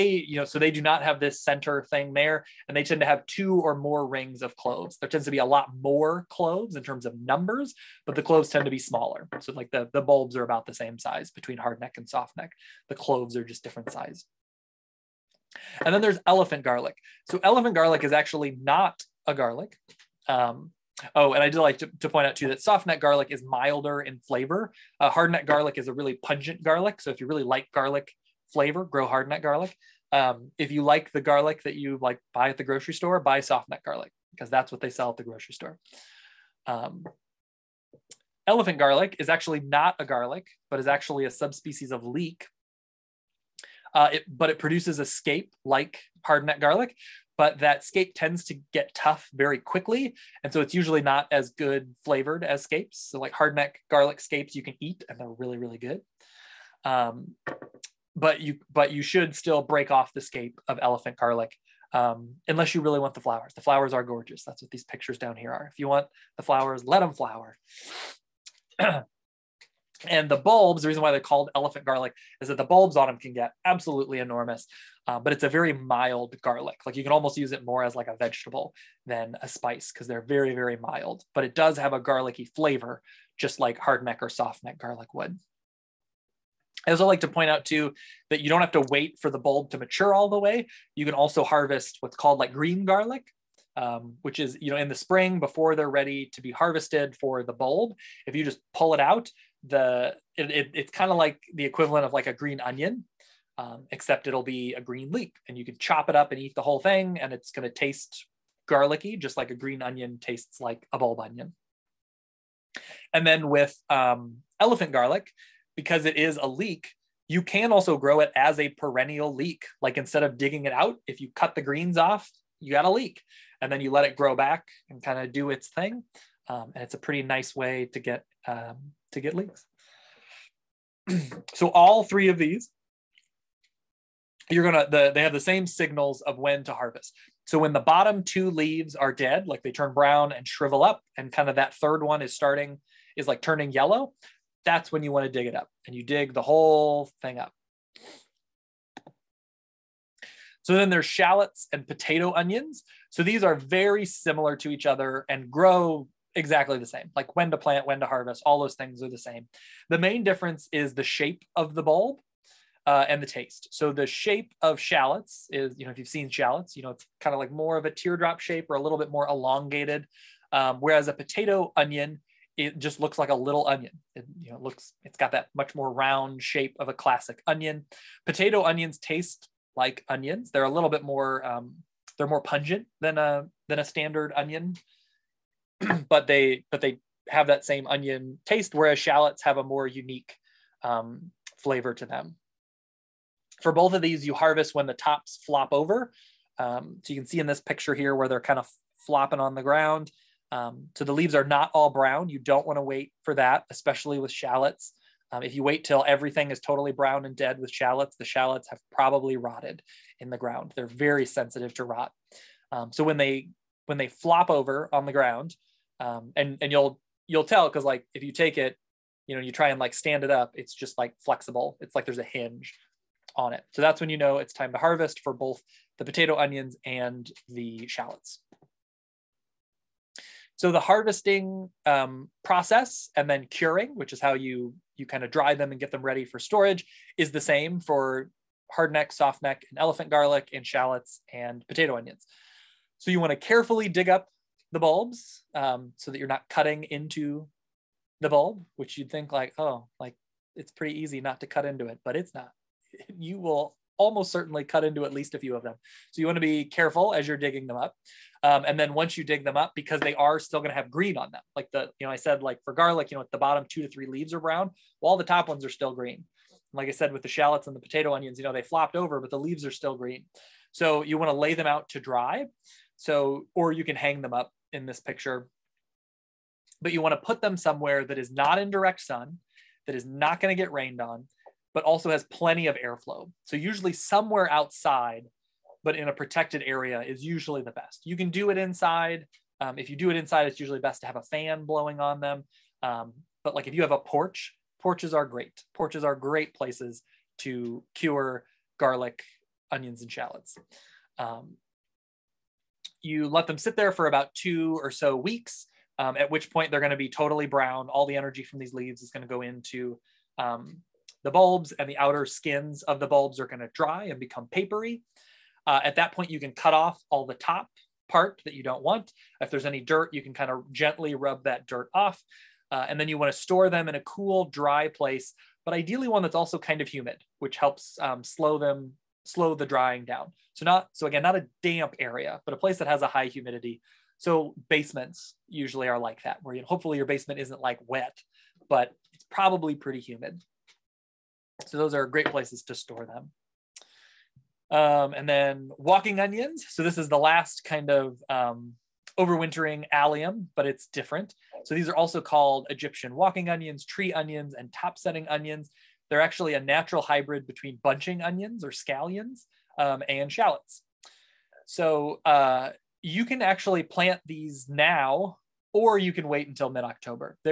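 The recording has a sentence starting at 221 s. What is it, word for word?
It's like there's a hinge on it.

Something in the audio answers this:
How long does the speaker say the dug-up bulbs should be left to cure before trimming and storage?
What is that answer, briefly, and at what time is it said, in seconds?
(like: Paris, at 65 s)
About 2 weeks, at 304 s.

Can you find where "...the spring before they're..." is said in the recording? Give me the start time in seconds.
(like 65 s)
94 s.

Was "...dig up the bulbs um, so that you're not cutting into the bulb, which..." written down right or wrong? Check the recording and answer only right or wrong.
right.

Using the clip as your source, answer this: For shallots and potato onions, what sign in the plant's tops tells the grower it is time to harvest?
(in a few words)
Tops flop over.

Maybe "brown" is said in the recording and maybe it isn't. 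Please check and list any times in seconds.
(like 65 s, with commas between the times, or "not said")
139 s, 201 s, 206 s, 264 s, 307 s.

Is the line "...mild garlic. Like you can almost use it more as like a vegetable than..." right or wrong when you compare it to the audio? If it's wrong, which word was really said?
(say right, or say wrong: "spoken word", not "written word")
right.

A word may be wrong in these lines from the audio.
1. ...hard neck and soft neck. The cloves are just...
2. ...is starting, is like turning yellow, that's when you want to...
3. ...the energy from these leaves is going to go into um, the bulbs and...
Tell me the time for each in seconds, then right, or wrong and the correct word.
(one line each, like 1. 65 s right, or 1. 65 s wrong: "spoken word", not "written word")
1. 11 s right
2. 142 s right
3. 308 s right.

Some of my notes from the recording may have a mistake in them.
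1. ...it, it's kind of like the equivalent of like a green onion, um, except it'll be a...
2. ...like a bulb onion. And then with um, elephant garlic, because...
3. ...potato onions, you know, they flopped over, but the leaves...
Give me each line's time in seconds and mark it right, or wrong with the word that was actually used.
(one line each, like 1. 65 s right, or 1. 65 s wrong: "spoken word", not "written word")
1. 100 s right
2. 110 s right
3. 267 s right.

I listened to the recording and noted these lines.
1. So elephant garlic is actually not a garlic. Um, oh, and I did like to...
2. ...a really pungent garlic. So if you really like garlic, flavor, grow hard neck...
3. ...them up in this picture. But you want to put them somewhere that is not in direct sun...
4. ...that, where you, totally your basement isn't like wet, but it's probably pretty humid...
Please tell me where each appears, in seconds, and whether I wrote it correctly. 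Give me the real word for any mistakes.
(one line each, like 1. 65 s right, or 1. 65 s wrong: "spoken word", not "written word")
1. 17 s right
2. 25 s right
3. 274 s right
4. 336 s wrong: "hopefully", not "totally".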